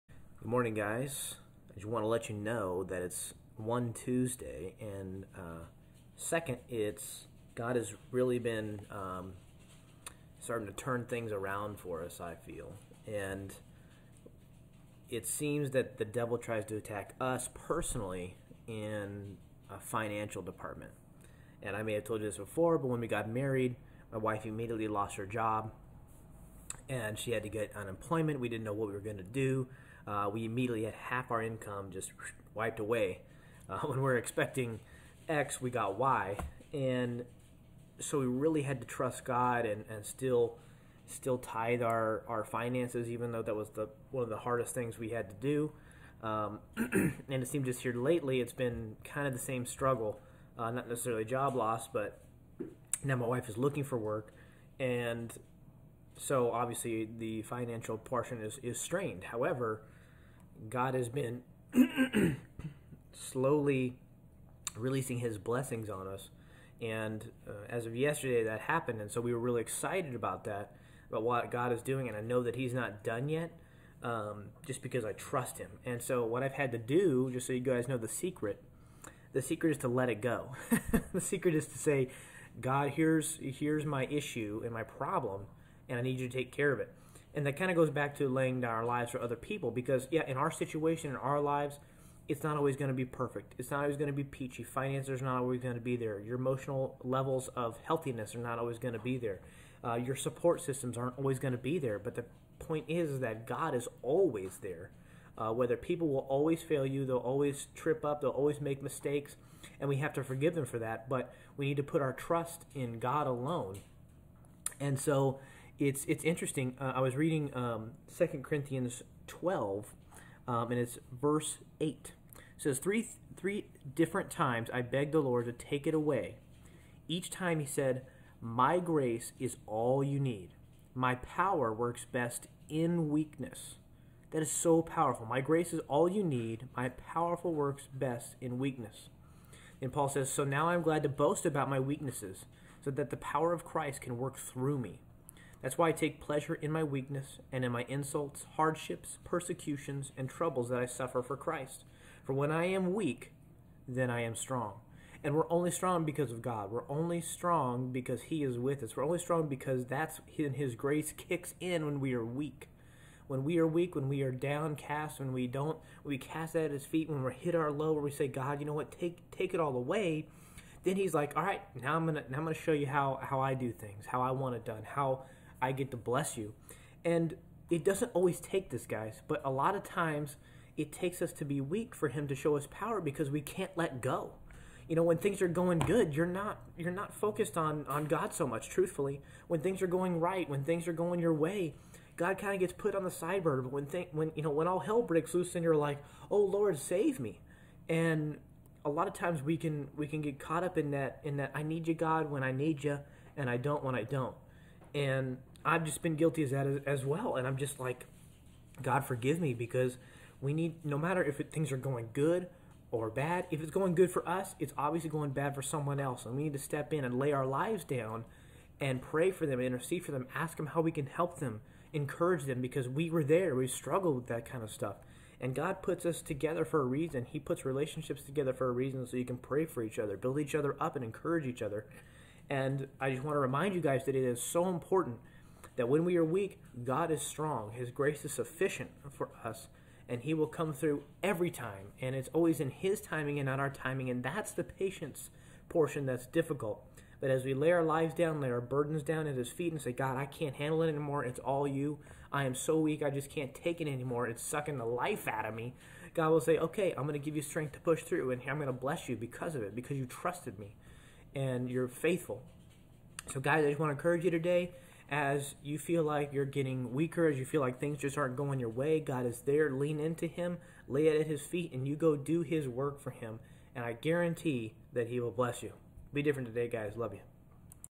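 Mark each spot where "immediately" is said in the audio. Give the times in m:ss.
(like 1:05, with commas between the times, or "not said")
0:24, 0:30.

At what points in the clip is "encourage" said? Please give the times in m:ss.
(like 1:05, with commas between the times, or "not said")
3:41, 3:51, 4:23.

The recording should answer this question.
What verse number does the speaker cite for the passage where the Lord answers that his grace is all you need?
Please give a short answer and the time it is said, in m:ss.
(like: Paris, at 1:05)
8, at 2:01.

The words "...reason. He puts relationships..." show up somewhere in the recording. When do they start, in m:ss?
3:46.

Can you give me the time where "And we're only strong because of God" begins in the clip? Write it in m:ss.
2:35.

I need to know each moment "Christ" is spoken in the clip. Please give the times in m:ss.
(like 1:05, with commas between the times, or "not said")
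2:23, 2:31.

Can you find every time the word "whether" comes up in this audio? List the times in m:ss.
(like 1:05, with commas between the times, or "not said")
1:45.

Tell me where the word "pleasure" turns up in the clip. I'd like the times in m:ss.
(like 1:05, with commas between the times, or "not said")
2:26.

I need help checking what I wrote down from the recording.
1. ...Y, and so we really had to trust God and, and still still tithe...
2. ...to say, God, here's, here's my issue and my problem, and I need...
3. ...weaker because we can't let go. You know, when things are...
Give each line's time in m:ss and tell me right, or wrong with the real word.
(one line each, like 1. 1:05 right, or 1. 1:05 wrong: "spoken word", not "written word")
1. 0:35 right
2. 1:21 right
3. 3:02 wrong: "power", not "weaker".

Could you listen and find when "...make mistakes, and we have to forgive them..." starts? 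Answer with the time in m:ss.
1:48.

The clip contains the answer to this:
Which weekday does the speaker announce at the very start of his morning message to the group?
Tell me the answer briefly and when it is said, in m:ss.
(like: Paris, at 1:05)
Tuesday, at 0:03.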